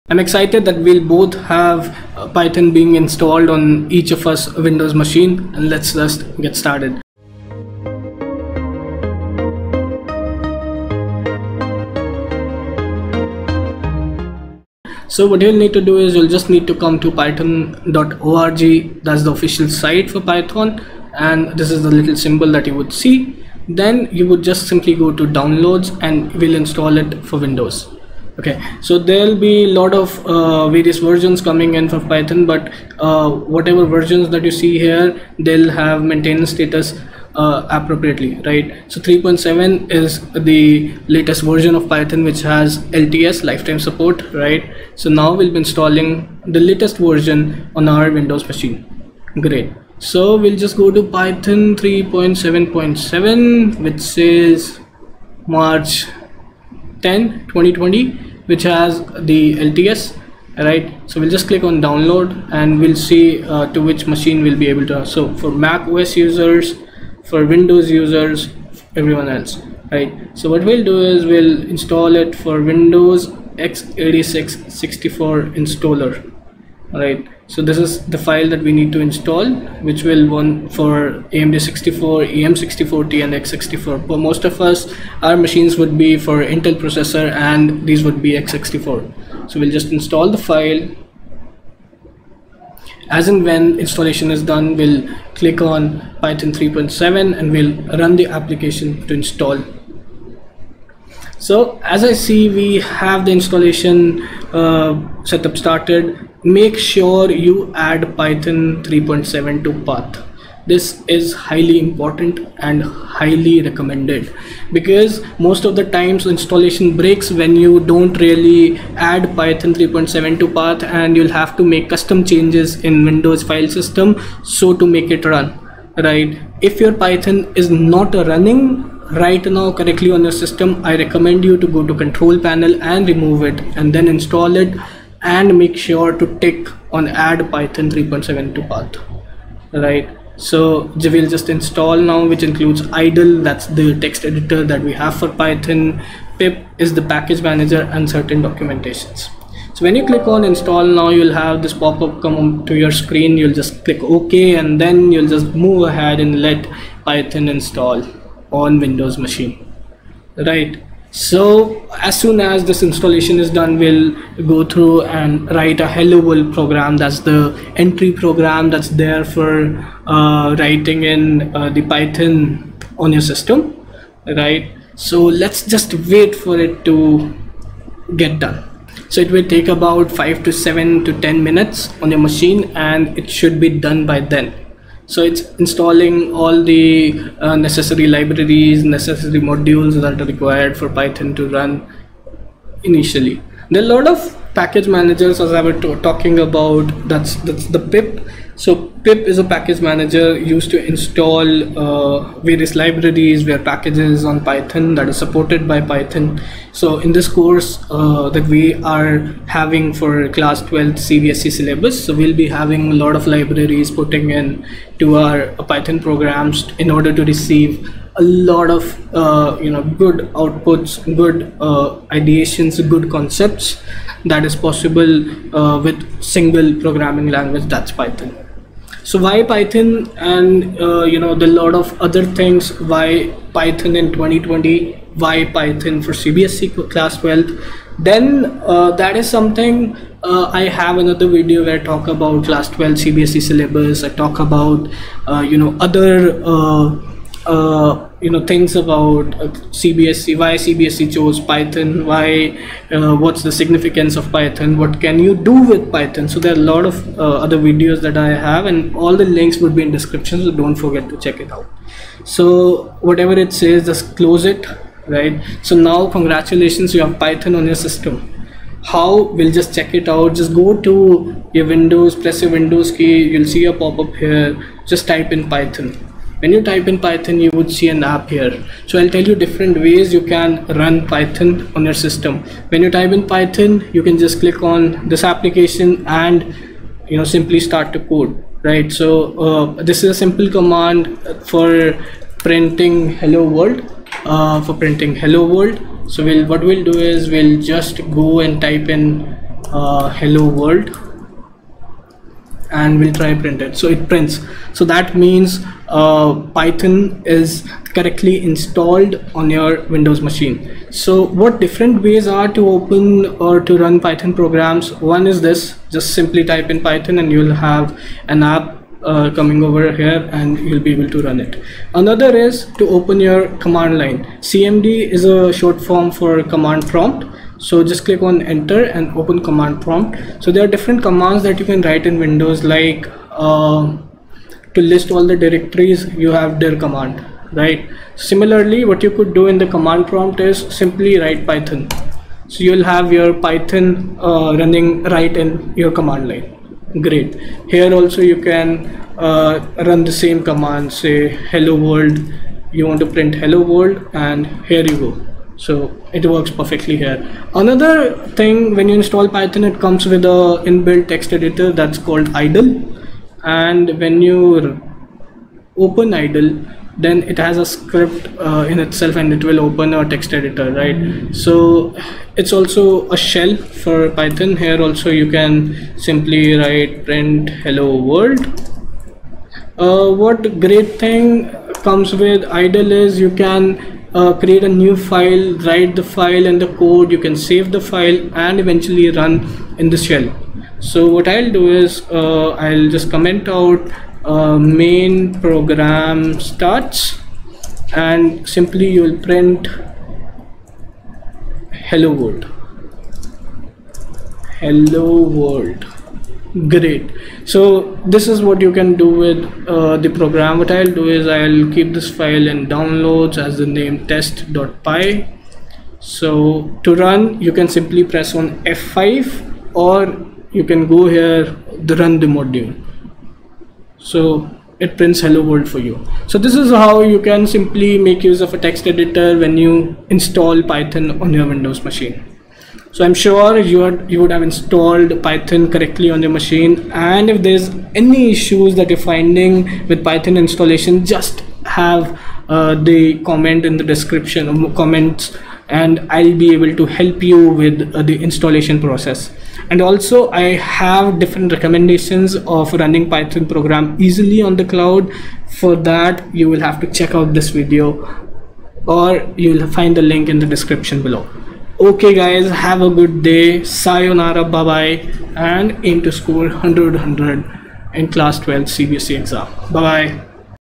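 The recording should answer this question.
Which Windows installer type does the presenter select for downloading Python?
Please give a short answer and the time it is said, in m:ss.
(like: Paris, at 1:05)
Windows x86 64 installer, at 1:12.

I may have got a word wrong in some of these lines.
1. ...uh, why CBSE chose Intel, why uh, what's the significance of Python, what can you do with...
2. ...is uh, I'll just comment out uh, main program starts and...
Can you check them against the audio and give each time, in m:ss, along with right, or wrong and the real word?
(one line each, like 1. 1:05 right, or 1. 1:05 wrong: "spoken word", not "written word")
1. 4:10 wrong: "Python", not "Intel"
2. 6:31 right.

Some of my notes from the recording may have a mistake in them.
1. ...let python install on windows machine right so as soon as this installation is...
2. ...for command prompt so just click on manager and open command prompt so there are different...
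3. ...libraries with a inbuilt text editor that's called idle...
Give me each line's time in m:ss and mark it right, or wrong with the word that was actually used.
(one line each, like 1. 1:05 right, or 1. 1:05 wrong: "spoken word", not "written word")
1. 2:36 right
2. 5:26 wrong: "enter", not "manager"
3. 5:59 wrong: "comes", not "libraries".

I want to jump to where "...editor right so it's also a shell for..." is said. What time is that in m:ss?
6:10.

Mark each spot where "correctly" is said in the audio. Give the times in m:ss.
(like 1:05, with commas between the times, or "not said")
2:09, 5:07, 7:15.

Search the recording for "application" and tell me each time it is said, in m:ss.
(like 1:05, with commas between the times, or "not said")
1:38, 4:45.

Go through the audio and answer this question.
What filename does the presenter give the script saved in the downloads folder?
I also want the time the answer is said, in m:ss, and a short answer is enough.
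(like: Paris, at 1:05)
test.py, at 6:54.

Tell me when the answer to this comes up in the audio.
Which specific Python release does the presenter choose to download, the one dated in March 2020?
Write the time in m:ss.
0:51.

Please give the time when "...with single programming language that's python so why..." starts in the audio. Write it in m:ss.
3:45.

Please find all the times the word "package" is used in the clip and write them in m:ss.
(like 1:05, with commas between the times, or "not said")
2:27, 3:14, 3:19, 3:23.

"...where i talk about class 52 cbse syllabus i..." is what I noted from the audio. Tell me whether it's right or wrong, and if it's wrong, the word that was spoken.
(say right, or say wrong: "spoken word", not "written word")
wrong: "12", not "52".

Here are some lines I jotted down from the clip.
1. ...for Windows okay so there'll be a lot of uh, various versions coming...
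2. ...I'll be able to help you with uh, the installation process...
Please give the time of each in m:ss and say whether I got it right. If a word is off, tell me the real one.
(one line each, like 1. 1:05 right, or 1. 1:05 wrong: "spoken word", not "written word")
1. 0:27 right
2. 7:26 right.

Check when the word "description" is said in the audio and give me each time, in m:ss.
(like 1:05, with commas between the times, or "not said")
4:19, 7:23, 7:40.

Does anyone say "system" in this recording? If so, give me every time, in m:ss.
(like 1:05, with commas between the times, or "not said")
2:03, 2:10, 2:53, 4:27, 4:42.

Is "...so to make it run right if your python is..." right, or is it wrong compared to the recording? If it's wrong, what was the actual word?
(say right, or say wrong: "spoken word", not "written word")
right.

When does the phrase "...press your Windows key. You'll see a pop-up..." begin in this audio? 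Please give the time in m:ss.
4:32.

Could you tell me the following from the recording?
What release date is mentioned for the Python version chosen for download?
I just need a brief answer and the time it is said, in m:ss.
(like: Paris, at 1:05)
March 10 2020, at 0:55.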